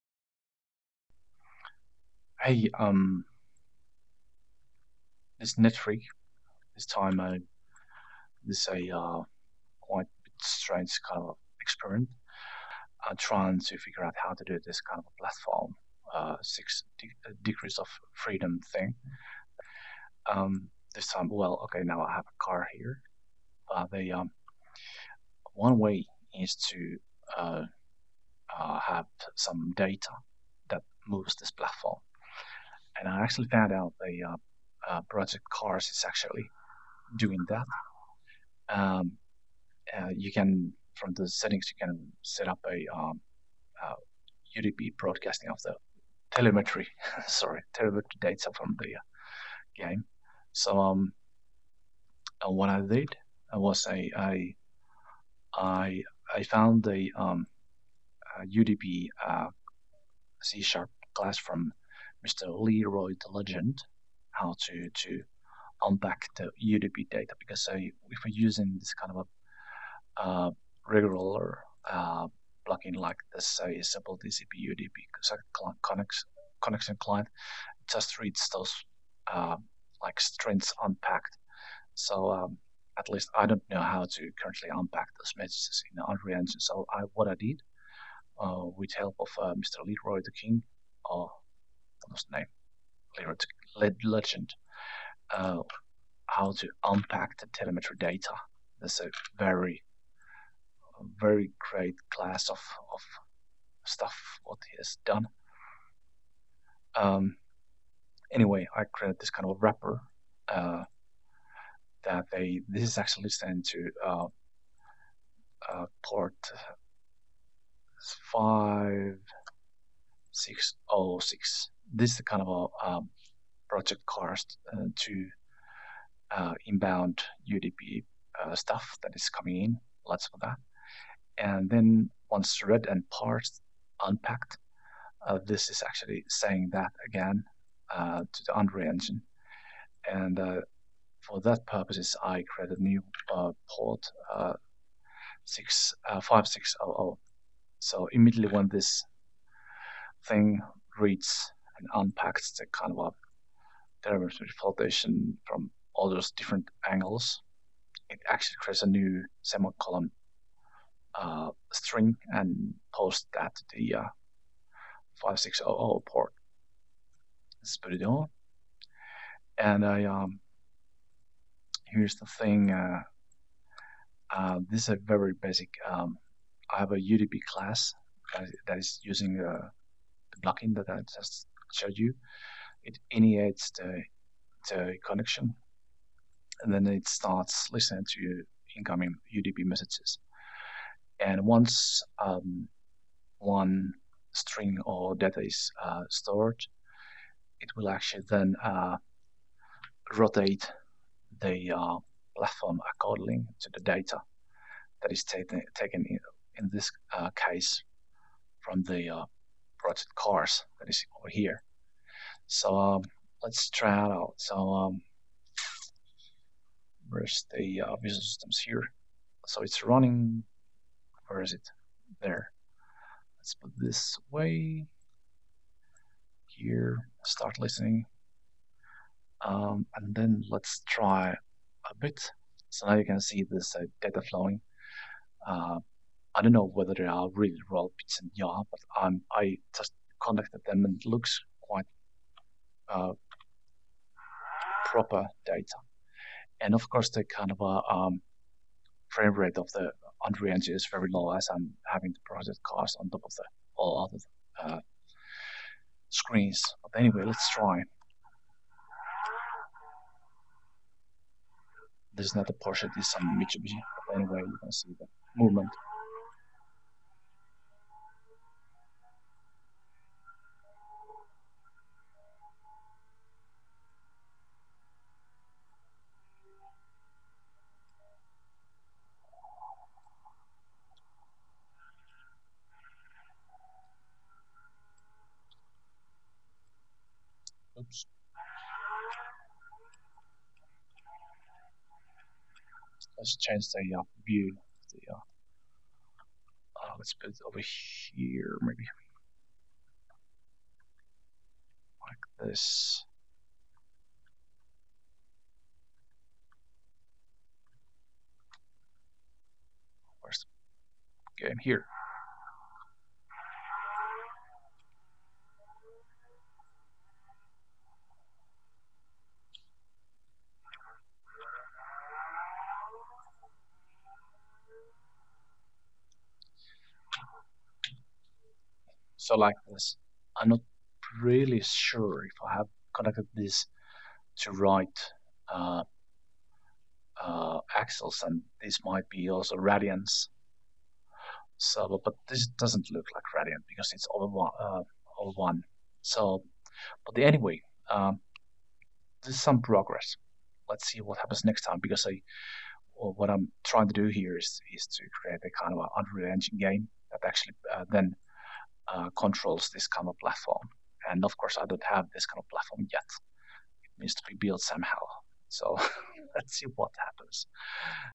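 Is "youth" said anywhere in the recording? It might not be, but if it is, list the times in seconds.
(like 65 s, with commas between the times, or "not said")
not said.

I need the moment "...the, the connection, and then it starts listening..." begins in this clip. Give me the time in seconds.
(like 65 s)
183 s.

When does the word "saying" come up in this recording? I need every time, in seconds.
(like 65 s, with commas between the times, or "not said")
136 s.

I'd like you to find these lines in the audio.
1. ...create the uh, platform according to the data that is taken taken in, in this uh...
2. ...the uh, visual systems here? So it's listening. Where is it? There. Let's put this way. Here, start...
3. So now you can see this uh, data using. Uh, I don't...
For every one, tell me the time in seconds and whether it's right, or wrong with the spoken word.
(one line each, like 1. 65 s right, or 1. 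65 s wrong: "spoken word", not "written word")
1. 200 s wrong: "rotate", not "create"
2. 217 s wrong: "running", not "listening"
3. 232 s wrong: "flowing", not "using".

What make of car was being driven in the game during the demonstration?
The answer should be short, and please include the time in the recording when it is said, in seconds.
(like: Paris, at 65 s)
Mitsubishi, at 263 s.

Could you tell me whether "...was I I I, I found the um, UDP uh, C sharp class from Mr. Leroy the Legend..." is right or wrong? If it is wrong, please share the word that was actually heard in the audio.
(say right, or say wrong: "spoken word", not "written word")
right.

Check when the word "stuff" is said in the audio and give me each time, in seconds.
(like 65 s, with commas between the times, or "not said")
103 s, 128 s.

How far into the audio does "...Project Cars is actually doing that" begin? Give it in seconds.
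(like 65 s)
35 s.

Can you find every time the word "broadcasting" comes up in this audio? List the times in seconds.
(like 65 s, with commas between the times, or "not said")
44 s.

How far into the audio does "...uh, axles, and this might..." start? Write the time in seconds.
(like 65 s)
337 s.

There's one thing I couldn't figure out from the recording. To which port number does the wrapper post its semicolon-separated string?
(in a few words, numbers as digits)
5600.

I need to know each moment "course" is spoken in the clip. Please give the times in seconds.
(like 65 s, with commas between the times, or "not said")
246 s, 361 s.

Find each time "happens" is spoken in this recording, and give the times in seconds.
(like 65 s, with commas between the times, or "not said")
351 s, 366 s.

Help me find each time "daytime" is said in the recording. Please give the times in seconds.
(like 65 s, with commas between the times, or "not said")
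not said.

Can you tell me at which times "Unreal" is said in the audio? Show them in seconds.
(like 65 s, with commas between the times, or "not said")
86 s, 138 s, 250 s, 355 s.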